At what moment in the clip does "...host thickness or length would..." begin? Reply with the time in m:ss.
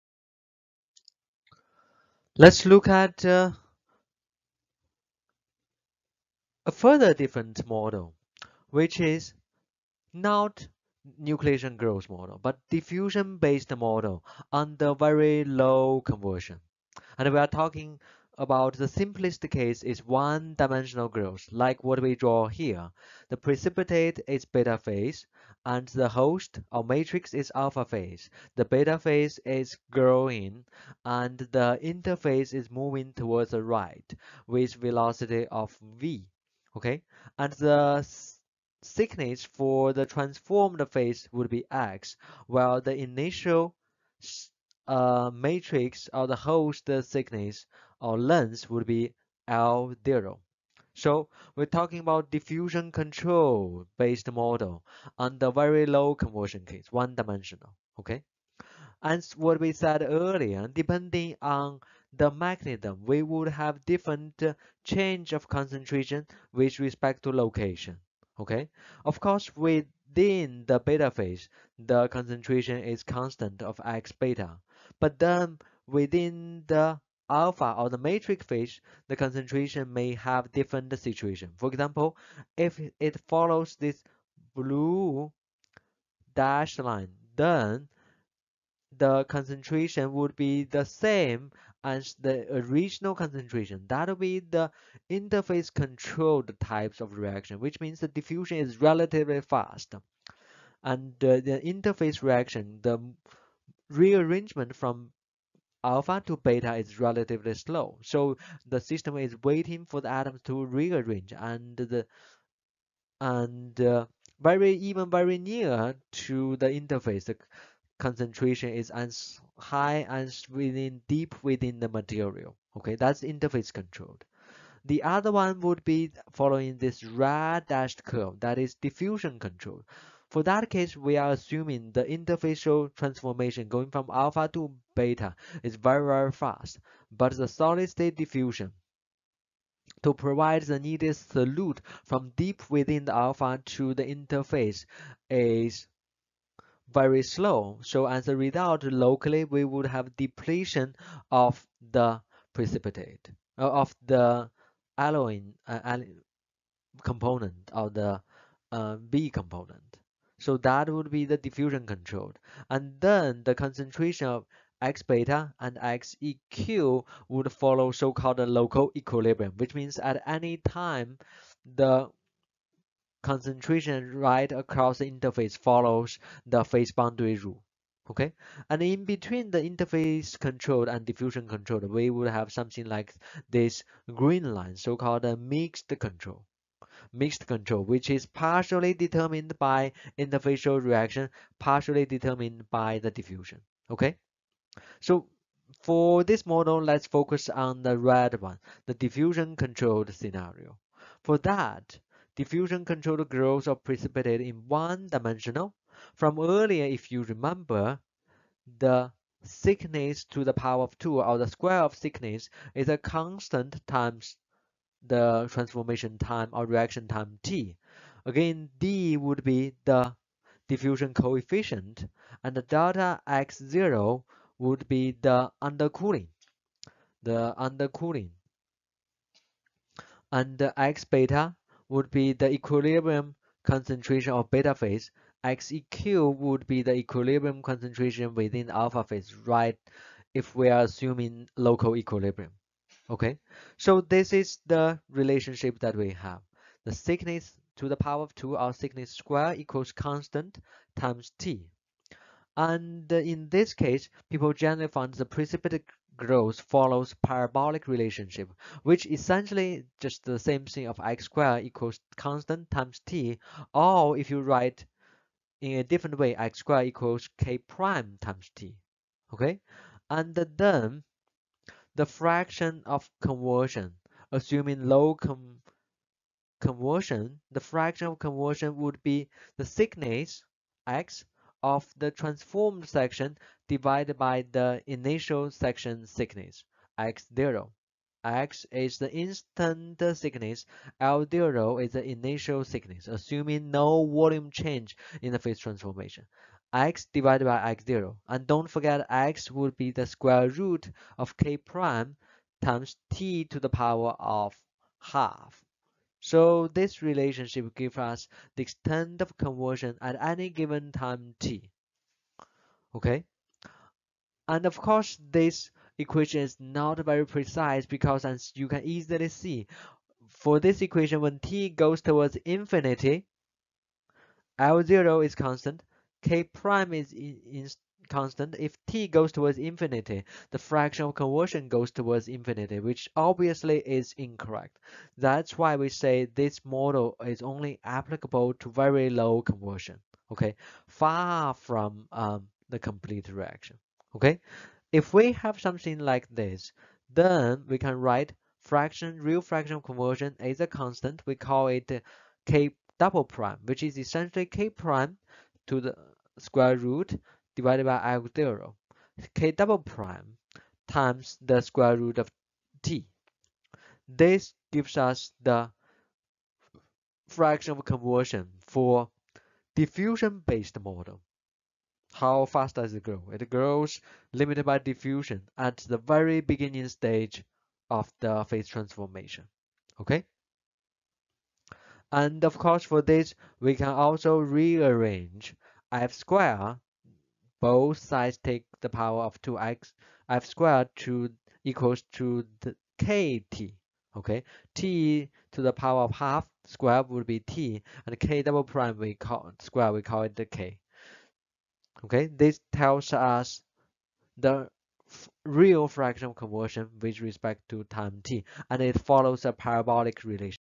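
0:46.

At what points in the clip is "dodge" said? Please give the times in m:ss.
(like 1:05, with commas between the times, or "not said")
not said.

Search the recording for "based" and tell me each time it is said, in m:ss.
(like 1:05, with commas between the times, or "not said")
0:12, 0:53, 6:09.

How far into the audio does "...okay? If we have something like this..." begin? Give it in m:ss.
5:44.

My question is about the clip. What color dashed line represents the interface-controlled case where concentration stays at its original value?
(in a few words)
blue.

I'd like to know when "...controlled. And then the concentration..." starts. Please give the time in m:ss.
2:41.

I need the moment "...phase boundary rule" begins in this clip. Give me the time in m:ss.
2:56.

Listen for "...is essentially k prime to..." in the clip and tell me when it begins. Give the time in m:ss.
5:53.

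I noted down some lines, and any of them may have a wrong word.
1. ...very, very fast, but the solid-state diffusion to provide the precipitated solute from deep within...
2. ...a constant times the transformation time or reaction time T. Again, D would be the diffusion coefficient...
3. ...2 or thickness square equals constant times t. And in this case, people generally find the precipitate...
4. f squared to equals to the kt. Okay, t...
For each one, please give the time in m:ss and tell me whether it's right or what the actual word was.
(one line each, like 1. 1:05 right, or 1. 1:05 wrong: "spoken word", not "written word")
1. 2:15 wrong: "needed", not "precipitated"
2. 3:32 right
3. 4:08 right
4. 6:30 right.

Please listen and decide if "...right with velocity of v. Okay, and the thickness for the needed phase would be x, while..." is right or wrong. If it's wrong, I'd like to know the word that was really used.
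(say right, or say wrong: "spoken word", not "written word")
wrong: "transformed", not "needed".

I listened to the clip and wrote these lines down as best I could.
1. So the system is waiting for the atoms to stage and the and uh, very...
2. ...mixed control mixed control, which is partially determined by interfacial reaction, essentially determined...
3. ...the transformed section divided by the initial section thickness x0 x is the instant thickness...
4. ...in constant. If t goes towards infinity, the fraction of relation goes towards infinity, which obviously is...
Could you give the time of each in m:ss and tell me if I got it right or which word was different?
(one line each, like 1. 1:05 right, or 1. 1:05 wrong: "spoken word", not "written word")
1. 1:48 wrong: "rearrange", not "stage"
2. 3:05 wrong: "partially", not "essentially"
3. 4:41 right
4. 5:27 wrong: "conversion", not "relation".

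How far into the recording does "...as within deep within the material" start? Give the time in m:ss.
2:00.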